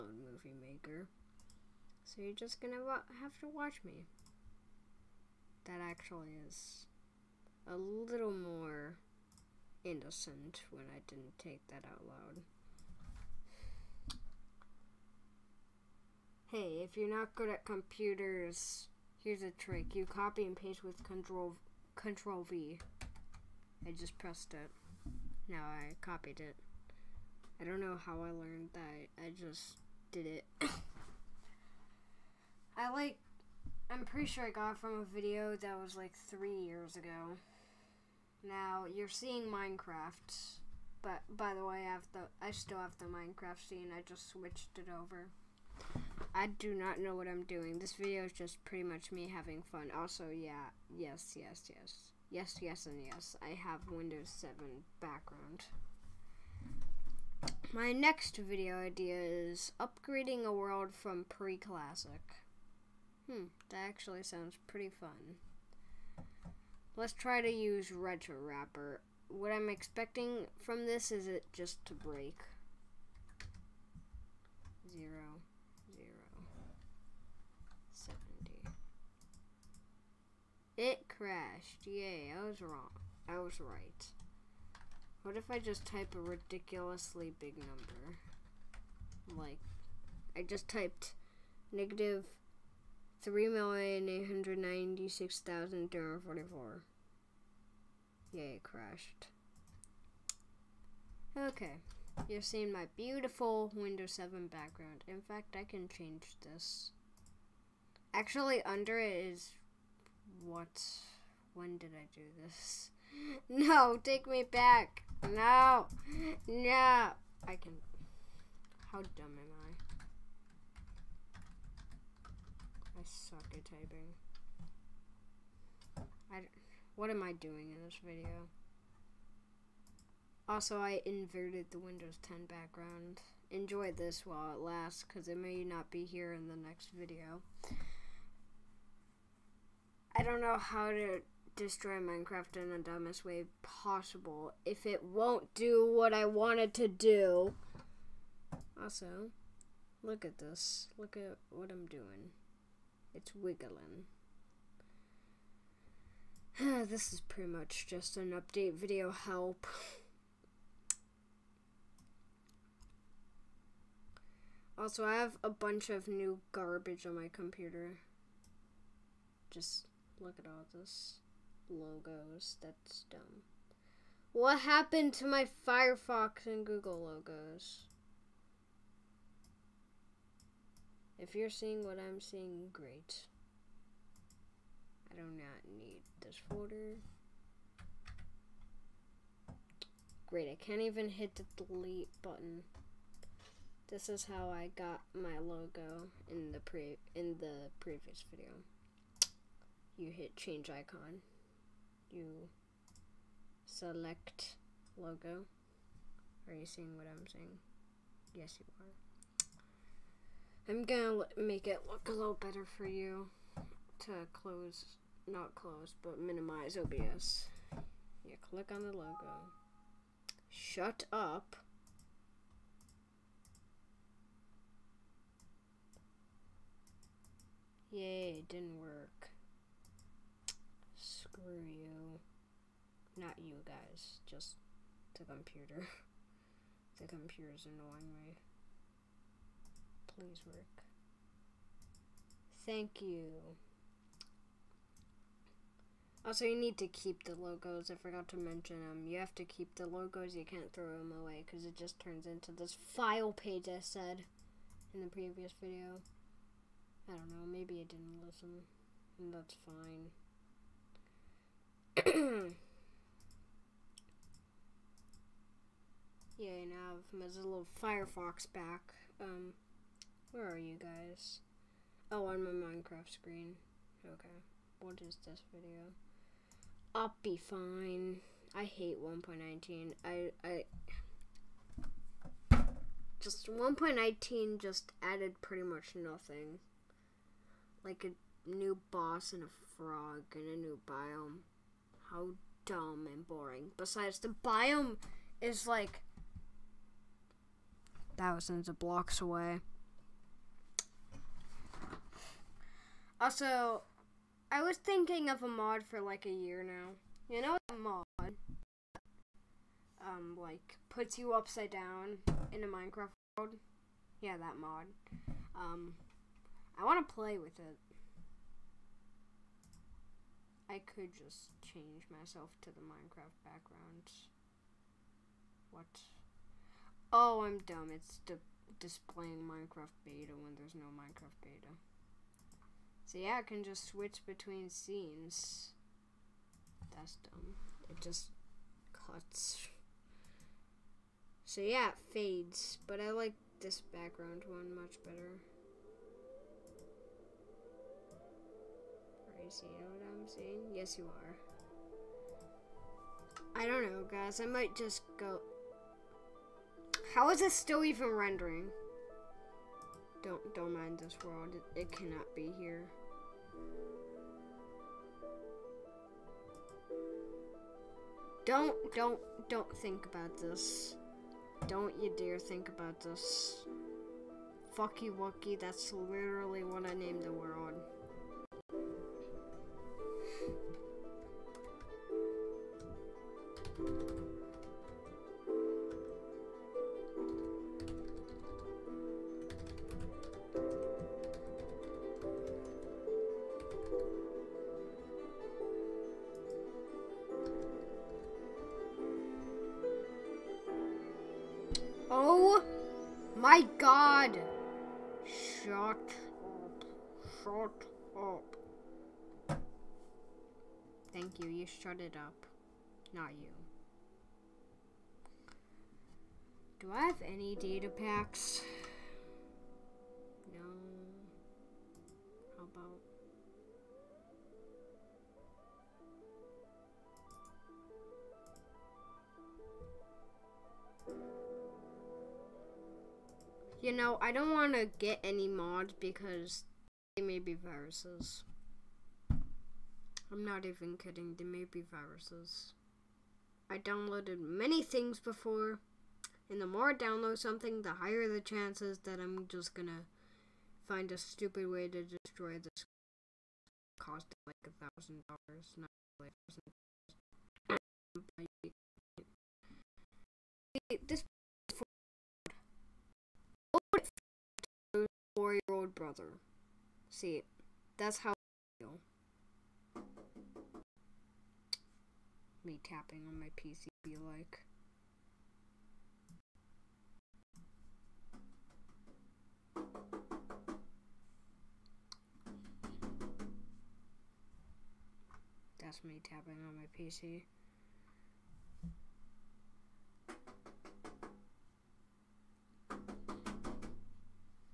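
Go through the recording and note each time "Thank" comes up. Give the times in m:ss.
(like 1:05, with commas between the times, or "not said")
4:02, 6:51.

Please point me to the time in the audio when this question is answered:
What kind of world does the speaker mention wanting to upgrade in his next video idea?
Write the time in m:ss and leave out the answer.
1:01.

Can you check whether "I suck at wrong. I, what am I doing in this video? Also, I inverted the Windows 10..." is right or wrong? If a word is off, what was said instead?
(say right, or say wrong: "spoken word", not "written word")
wrong: "typing", not "wrong".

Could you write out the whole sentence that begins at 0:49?
Also, yeah, yes, yes, yes, yes, yes, and yes.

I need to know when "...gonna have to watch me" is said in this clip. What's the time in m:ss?
0:02.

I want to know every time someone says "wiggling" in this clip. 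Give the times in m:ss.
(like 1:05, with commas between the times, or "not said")
2:33.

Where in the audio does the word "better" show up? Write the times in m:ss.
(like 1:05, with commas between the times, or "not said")
3:32, 5:45.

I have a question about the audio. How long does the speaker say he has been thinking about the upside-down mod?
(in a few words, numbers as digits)
a year.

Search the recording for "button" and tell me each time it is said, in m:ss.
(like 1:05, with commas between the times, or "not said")
3:12.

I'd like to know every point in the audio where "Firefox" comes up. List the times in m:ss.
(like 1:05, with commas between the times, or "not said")
2:55, 4:27.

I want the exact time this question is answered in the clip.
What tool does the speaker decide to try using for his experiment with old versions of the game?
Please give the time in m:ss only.
1:07.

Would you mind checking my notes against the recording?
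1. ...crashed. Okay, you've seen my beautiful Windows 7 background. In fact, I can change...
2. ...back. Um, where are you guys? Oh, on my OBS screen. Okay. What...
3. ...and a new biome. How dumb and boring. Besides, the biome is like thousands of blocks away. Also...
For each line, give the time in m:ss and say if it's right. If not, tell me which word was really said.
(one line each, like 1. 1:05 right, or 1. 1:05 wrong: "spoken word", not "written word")
1. 1:38 right
2. 4:28 wrong: "Minecraft", not "OBS"
3. 4:50 right.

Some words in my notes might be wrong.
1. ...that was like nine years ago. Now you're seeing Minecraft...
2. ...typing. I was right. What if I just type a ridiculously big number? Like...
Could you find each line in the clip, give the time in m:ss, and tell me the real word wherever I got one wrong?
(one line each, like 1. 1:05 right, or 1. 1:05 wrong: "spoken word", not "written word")
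1. 0:35 wrong: "three", not "nine"
2. 1:22 wrong: "wrong", not "typing".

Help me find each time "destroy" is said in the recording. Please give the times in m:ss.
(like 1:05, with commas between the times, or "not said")
2:21, 7:32.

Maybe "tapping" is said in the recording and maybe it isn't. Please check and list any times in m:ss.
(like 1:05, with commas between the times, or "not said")
7:52, 8:06.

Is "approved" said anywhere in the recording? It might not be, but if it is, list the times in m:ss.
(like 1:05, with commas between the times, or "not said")
not said.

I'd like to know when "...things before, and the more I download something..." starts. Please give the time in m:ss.
7:24.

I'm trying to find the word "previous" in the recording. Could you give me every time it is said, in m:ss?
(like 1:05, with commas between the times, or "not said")
3:17, 4:15.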